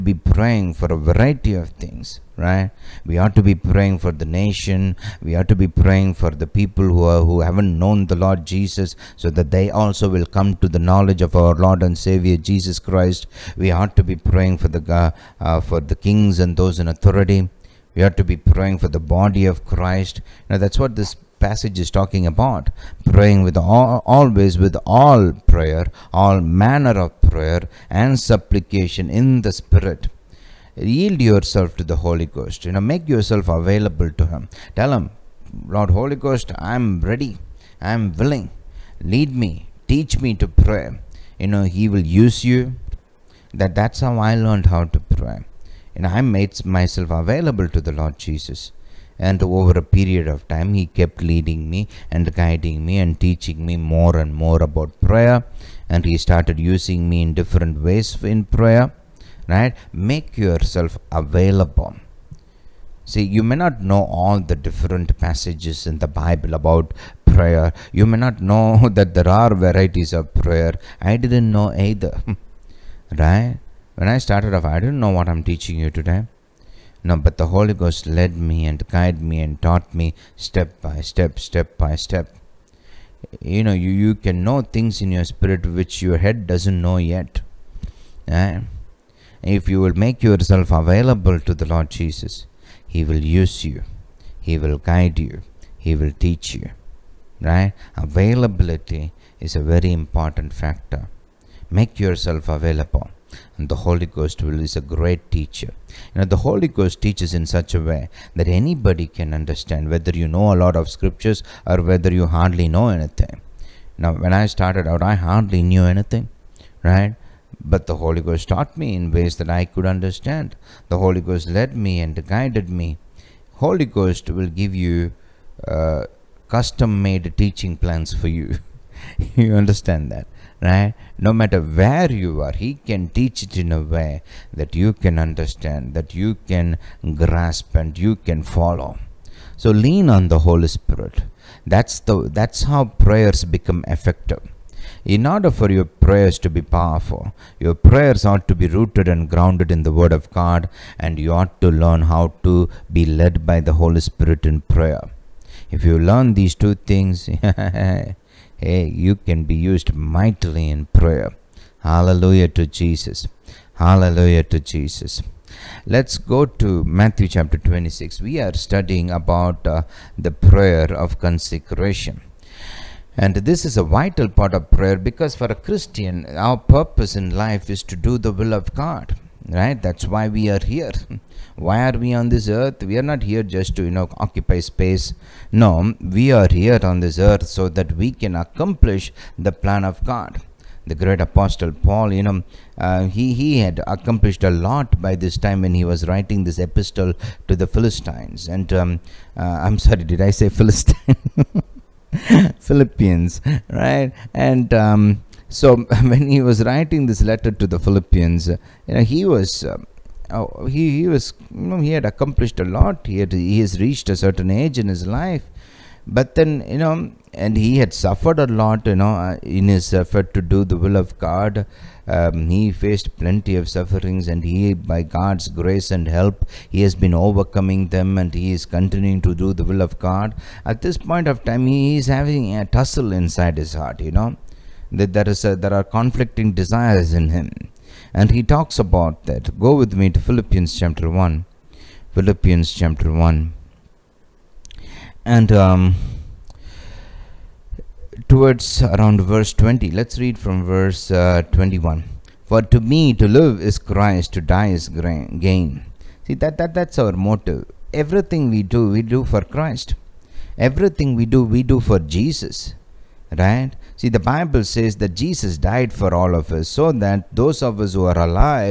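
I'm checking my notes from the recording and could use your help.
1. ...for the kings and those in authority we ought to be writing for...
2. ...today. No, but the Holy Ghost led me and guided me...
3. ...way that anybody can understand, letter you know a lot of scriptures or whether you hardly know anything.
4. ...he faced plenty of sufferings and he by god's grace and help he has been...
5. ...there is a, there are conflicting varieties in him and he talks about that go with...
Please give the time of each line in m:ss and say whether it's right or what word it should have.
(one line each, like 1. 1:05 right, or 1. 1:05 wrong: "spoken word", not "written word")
1. 0:15 wrong: "praying", not "writing"
2. 1:15 right
3. 1:47 wrong: "whether", not "letter"
4. 3:42 right
5. 3:55 wrong: "desires", not "varieties".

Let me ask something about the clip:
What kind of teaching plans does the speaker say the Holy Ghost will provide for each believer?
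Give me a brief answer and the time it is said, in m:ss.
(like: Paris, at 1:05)
Custom-made, at 2:06.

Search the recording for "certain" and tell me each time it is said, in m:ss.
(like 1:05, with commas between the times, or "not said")
3:34.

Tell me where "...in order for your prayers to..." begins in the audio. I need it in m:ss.
2:25.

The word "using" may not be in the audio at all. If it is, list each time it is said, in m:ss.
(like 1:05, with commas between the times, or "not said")
0:56.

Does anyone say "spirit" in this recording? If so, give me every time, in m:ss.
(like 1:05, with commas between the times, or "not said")
0:29, 1:25, 2:20, 2:34.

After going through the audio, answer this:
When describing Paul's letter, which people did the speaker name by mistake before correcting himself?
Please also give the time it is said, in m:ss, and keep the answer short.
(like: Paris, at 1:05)
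Philistines, at 3:17.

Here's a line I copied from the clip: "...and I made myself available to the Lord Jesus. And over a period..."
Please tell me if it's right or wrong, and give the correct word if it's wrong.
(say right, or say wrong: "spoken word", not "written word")
right.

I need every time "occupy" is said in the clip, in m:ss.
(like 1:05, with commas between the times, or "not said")
3:04.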